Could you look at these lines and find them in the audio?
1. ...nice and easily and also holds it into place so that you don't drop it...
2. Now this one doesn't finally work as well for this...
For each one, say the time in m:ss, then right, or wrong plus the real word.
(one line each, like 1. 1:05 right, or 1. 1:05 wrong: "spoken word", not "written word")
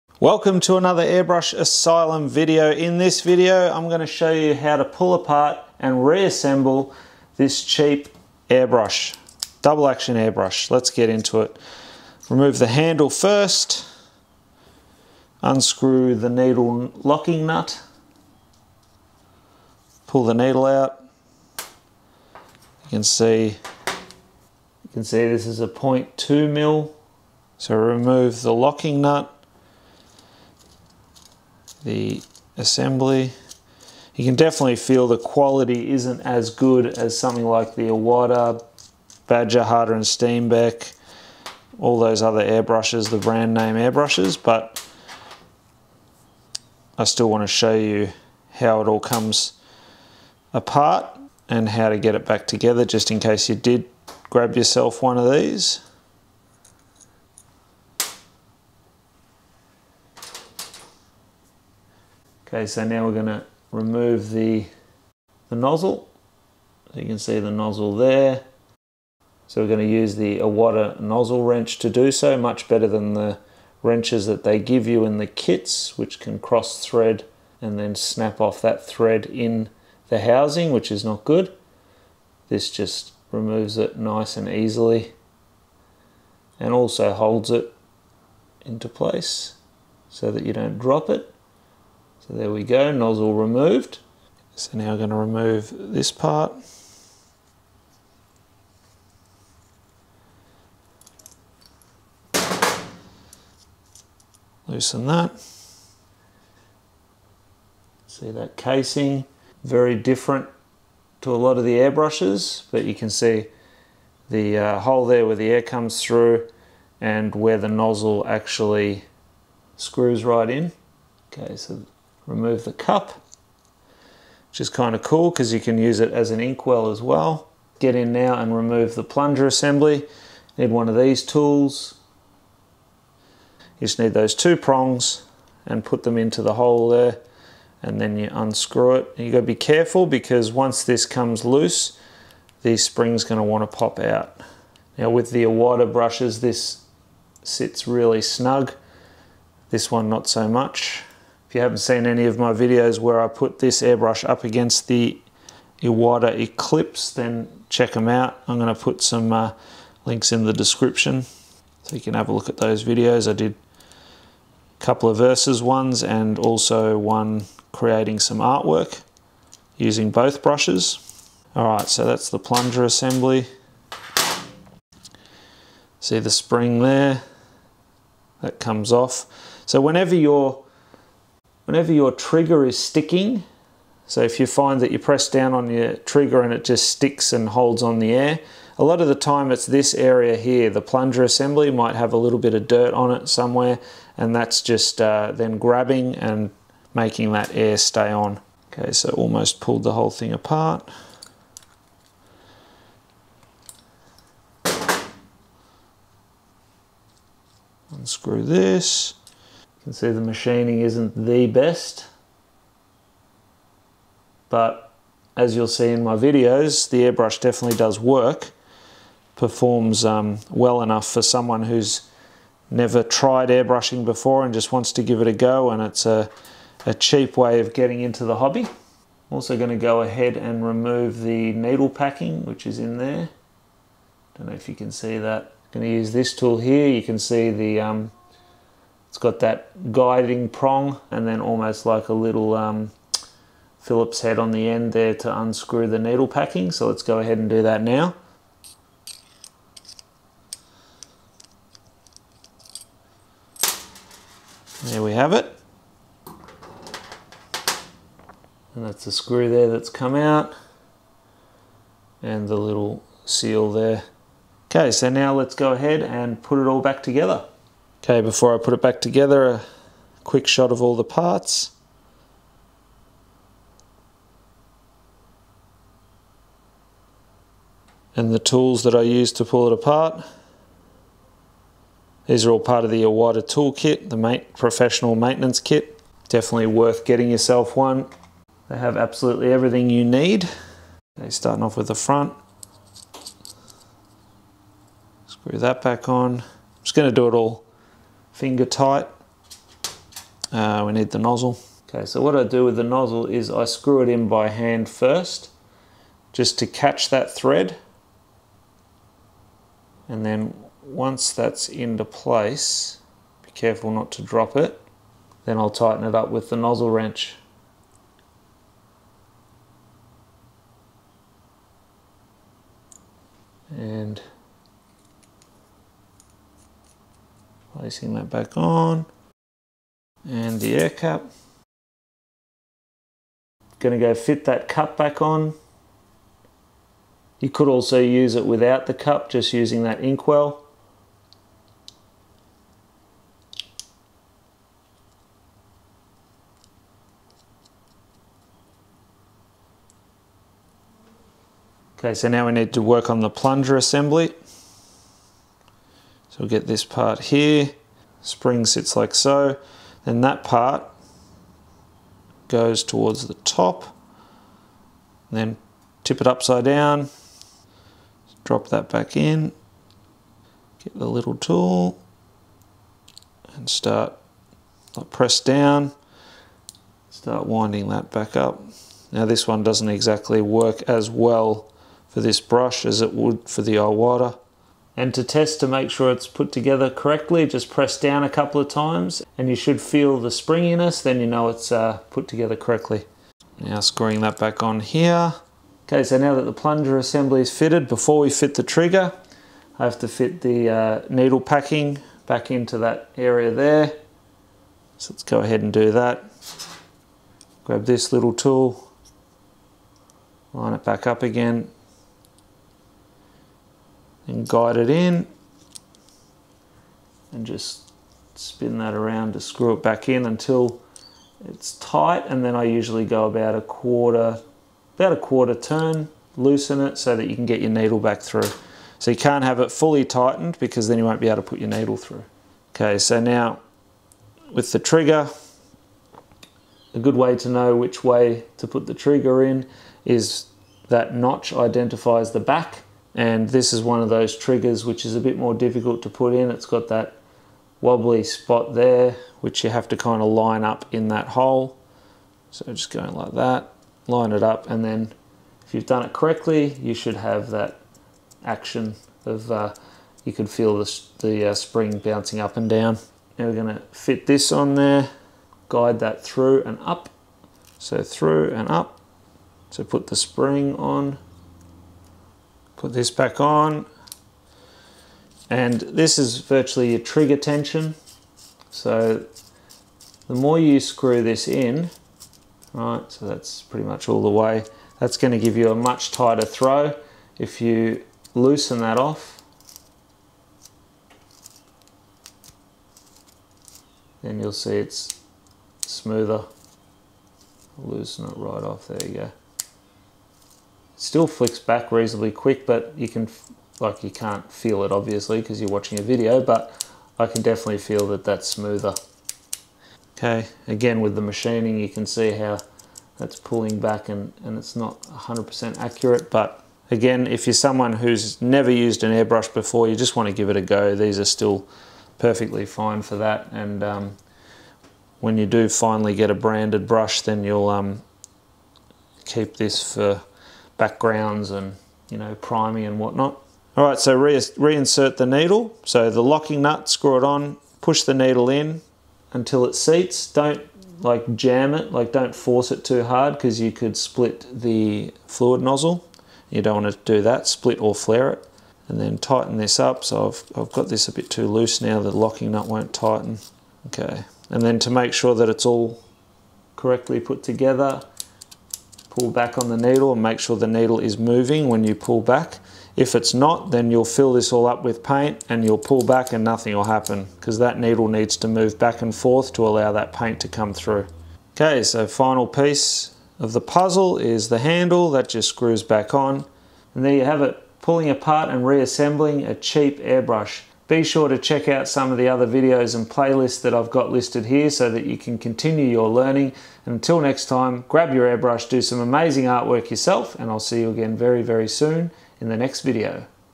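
1. 1:23 right
2. 6:19 wrong: "exactly", not "finally".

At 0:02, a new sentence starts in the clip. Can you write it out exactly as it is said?
In this video, I'm gonna show you how to pull apart and reassemble this cheap airbrush, double action airbrush.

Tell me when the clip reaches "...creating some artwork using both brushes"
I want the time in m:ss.
2:47.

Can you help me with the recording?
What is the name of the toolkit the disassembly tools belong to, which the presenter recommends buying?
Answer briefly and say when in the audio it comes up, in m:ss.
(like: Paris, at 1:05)
professional maintenance kit, at 4:44.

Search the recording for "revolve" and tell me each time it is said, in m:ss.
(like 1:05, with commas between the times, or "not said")
not said.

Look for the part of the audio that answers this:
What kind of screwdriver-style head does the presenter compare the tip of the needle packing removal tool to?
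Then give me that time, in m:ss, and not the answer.
4:03.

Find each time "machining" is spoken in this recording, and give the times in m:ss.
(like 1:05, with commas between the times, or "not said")
3:30, 8:31.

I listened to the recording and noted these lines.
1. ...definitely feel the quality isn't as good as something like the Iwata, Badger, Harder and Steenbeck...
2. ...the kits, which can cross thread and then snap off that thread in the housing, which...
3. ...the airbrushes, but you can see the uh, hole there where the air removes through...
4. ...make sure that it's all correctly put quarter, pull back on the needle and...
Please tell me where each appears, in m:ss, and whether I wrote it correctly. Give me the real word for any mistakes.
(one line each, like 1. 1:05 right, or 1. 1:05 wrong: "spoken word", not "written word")
1. 0:34 right
2. 1:15 right
3. 1:51 wrong: "comes", not "removes"
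4. 9:14 wrong: "together", not "quarter".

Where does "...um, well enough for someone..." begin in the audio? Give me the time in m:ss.
3:40.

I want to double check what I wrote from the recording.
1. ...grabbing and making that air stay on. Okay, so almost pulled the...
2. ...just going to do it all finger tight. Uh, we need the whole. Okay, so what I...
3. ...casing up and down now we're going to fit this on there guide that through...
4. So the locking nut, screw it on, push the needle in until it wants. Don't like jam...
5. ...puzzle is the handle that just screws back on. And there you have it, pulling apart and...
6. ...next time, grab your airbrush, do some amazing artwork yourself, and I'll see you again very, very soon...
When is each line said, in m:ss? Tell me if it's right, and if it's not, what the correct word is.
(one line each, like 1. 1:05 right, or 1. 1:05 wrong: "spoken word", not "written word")
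1. 3:15 right
2. 4:56 wrong: "nozzle", not "whole"
3. 7:41 wrong: "bouncing", not "casing"
4. 8:55 wrong: "seats", not "wants"
5. 9:33 right
6. 9:47 right.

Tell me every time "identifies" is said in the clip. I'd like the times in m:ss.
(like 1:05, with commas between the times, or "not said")
7:21.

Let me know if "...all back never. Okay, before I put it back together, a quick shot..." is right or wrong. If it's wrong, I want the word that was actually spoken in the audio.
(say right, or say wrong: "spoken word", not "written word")
wrong: "together", not "never".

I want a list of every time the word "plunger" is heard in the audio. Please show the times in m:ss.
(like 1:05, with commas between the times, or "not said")
2:09, 2:52, 3:10, 5:53, 6:36.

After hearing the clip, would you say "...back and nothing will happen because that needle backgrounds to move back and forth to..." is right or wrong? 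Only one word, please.
wrong.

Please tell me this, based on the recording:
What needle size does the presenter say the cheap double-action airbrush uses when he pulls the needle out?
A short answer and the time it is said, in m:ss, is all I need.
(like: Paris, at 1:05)
0.2 mil, at 0:25.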